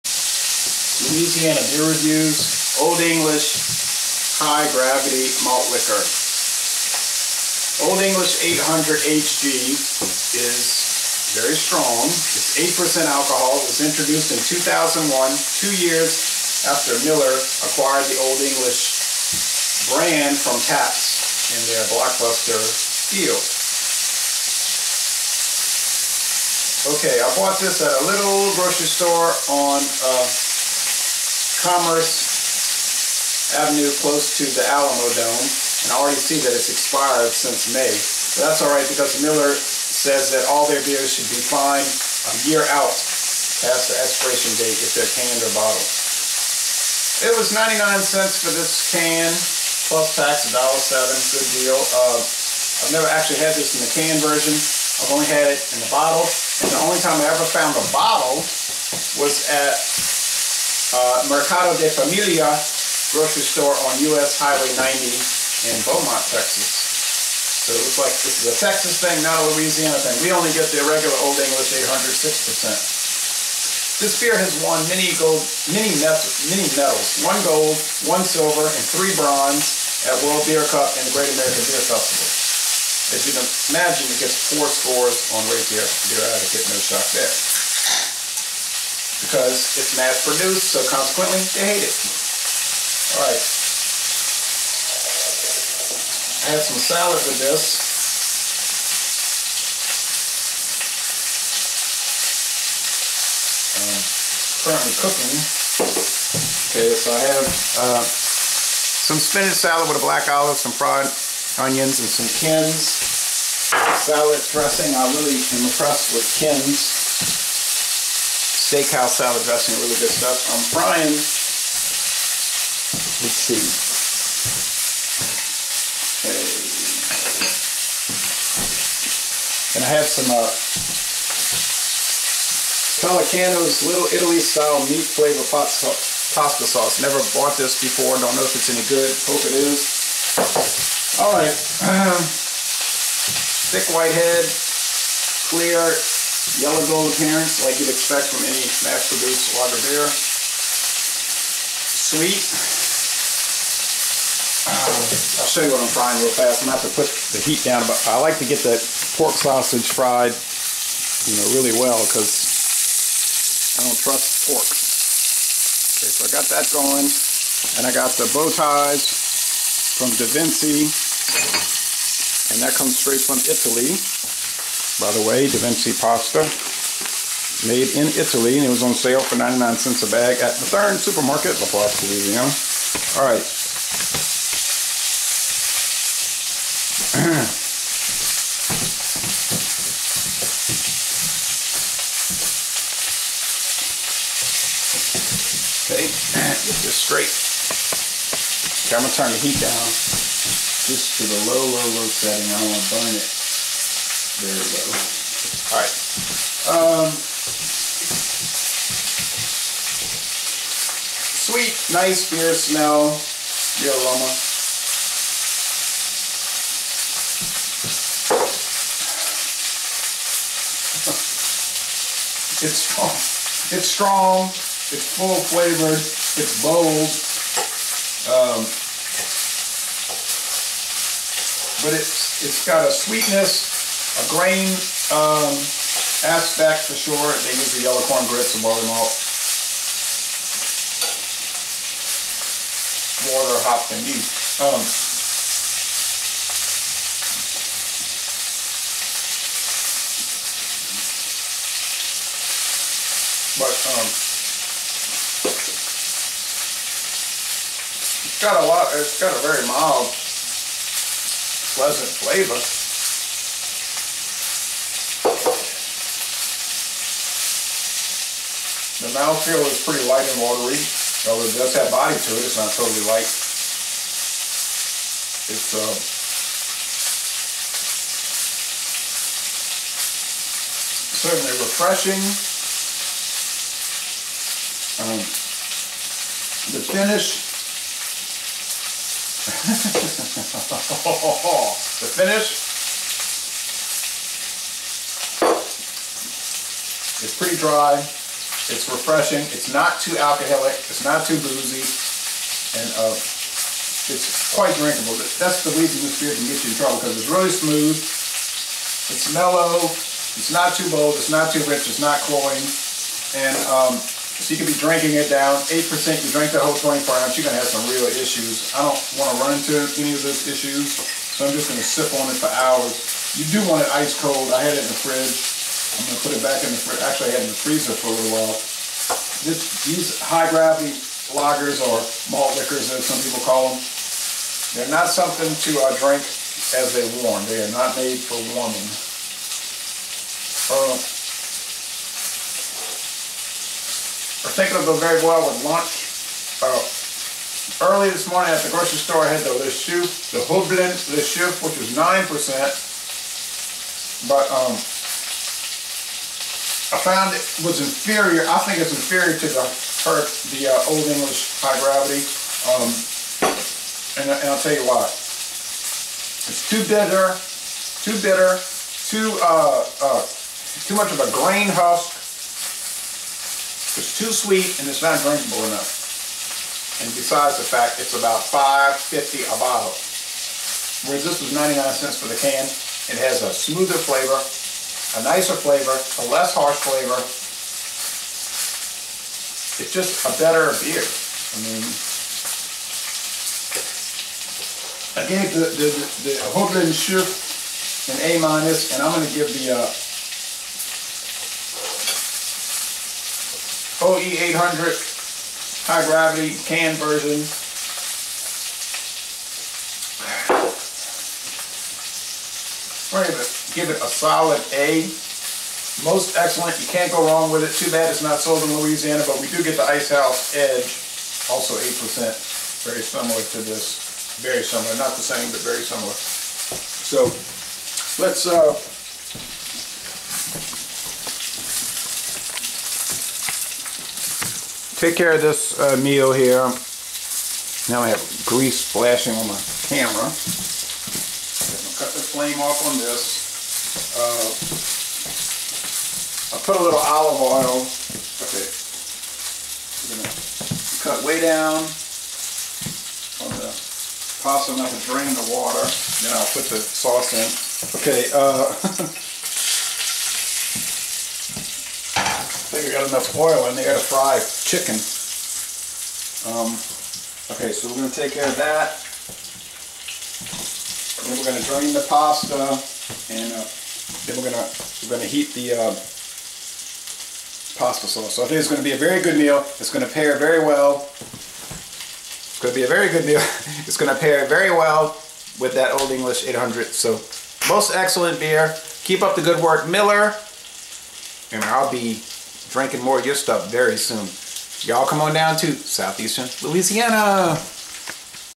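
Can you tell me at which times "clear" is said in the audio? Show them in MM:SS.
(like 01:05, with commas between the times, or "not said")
02:25.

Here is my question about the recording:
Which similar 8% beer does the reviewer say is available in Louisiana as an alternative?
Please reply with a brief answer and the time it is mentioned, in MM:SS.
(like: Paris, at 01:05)
Icehouse Edge, at 06:59.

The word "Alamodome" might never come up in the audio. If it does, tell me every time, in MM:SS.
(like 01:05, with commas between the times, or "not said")
00:34.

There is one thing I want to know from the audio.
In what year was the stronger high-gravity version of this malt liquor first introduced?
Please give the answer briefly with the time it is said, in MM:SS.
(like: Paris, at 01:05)
2001, at 00:14.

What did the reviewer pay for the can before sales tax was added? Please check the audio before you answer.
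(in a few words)
99 cents.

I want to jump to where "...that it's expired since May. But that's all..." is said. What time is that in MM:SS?
00:36.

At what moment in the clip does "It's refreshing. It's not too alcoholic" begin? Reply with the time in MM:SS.
04:58.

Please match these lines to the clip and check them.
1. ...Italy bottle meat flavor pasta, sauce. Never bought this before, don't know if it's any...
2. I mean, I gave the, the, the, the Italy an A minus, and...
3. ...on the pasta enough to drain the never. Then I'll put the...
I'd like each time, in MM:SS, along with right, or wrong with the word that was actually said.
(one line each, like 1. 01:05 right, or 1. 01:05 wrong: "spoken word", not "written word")
1. 02:14 wrong: "style", not "bottle"
2. 06:31 wrong: "Schiff", not "Italy"
3. 07:33 wrong: "water", not "never".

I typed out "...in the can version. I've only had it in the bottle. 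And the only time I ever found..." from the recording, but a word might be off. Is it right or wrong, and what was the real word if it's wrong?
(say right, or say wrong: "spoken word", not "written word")
right.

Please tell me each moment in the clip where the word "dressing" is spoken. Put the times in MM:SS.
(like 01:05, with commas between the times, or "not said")
01:54, 01:59.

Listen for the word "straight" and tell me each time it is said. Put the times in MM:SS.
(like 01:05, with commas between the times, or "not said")
02:52, 03:16.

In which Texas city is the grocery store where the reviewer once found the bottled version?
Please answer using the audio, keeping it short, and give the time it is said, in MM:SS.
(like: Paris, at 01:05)
Beaumont, at 01:05.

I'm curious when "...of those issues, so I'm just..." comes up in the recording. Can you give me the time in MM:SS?
05:20.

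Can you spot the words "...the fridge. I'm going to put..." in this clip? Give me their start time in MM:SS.
05:24.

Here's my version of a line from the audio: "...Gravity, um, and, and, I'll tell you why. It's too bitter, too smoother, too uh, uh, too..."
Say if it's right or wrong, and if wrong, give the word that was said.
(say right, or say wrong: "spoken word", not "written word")
wrong: "bitter", not "smoother".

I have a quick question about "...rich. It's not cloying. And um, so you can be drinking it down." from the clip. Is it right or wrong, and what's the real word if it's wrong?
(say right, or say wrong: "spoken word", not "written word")
right.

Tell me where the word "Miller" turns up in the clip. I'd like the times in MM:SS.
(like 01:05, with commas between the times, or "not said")
00:17, 00:39, 08:09.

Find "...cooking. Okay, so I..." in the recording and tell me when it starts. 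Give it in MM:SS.
01:44.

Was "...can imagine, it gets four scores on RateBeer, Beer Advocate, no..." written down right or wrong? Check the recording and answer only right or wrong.
right.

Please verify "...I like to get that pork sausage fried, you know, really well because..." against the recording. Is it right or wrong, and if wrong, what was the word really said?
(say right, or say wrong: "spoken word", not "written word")
right.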